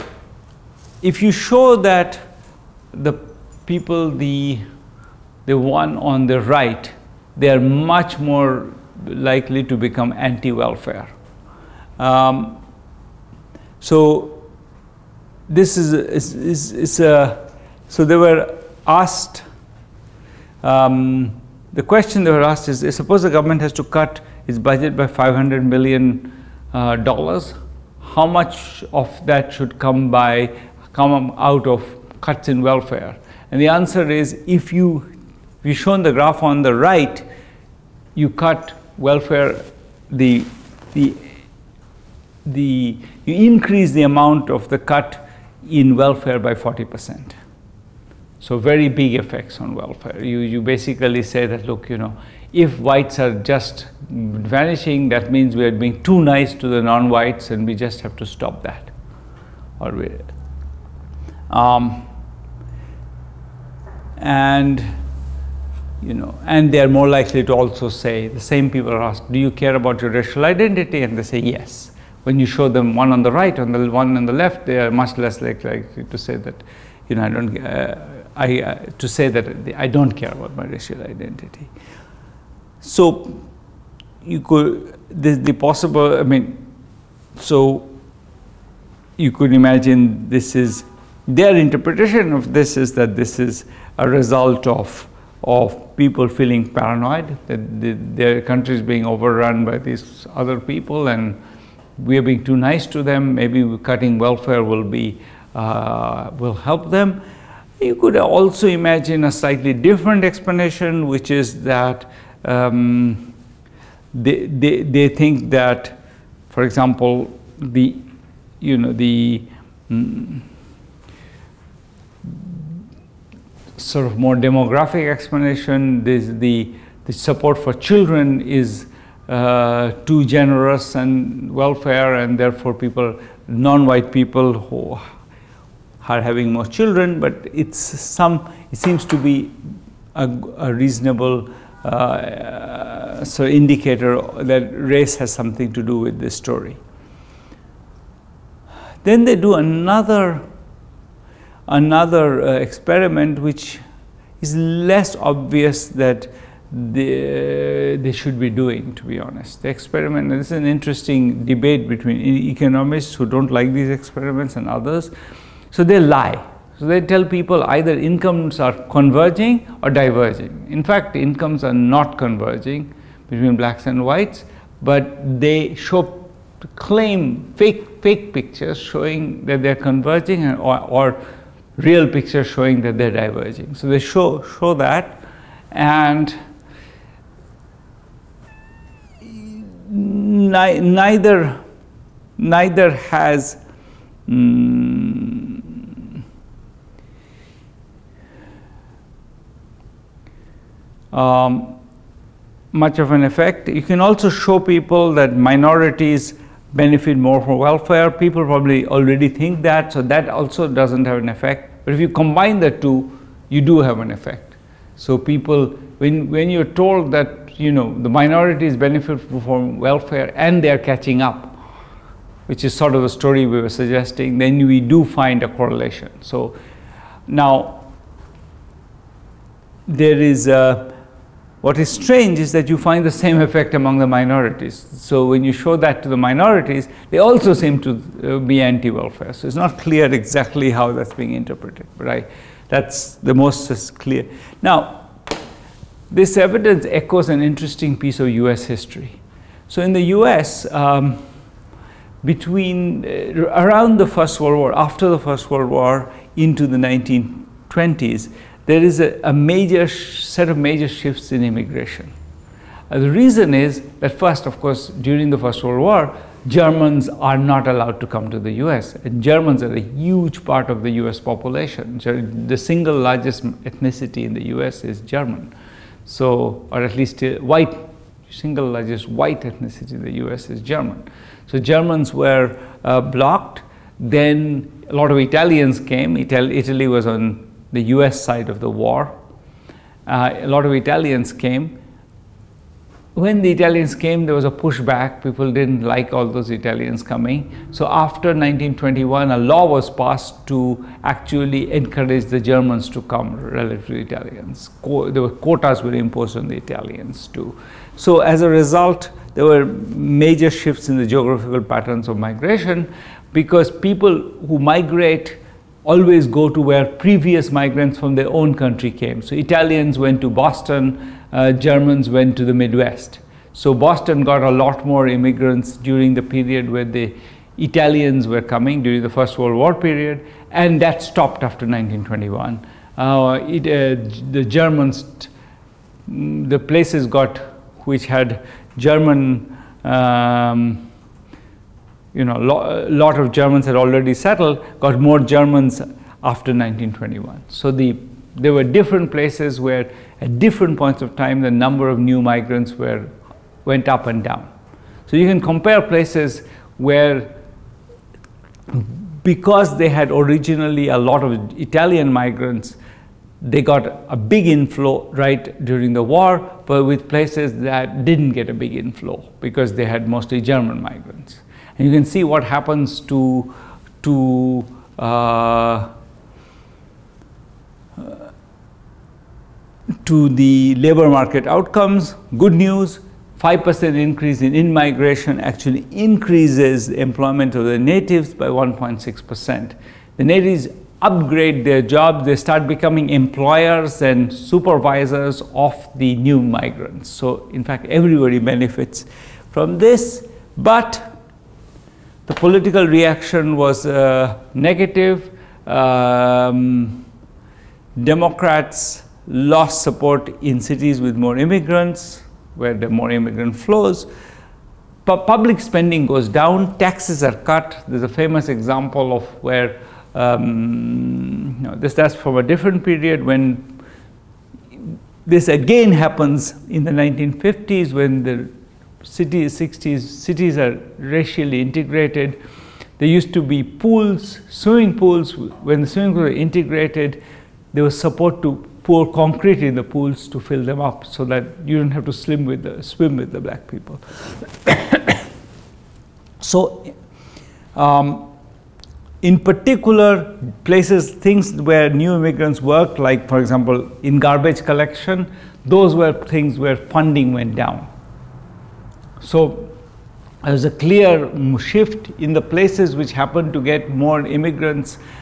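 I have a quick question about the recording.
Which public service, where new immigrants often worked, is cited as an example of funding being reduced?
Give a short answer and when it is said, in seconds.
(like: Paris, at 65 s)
Garbage collection, at 454 s.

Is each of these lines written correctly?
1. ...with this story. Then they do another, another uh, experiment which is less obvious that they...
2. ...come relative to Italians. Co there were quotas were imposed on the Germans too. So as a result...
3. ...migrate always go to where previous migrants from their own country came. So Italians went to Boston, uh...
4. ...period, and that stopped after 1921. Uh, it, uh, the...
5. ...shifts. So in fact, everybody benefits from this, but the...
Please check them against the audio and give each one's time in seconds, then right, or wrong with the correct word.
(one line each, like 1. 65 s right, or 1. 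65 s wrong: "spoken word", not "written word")
1. 145 s right
2. 303 s wrong: "Italians", not "Germans"
3. 314 s right
4. 329 s right
5. 396 s wrong: "migrants", not "shifts".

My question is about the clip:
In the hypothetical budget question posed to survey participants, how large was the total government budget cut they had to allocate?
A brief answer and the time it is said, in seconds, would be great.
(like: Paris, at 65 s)
$500 million, at 25 s.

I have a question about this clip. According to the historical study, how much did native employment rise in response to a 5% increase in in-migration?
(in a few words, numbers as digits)
1.6%.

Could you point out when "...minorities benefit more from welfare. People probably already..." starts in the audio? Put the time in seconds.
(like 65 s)
205 s.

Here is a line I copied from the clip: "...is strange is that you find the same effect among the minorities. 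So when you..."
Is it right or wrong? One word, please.
right.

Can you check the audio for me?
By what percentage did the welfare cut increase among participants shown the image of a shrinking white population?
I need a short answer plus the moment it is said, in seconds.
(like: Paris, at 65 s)
40 percent, at 46 s.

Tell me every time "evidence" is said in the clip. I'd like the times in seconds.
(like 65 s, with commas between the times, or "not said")
246 s.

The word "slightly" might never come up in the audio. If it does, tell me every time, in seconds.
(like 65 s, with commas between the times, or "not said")
109 s.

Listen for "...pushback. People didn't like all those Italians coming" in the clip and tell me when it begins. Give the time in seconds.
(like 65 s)
294 s.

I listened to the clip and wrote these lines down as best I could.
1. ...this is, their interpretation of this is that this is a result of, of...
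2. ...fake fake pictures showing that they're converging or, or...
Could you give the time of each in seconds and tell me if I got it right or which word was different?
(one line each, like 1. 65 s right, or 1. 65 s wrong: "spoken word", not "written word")
1. 90 s right
2. 177 s right.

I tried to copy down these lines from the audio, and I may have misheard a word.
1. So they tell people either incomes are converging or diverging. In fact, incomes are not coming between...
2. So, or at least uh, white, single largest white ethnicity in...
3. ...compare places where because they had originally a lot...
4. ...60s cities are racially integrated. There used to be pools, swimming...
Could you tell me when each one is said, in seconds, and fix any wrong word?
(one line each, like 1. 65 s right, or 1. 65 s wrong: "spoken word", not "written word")
1. 166 s wrong: "converging", not "coming"
2. 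276 s right
3. 355 s right
4. 429 s right.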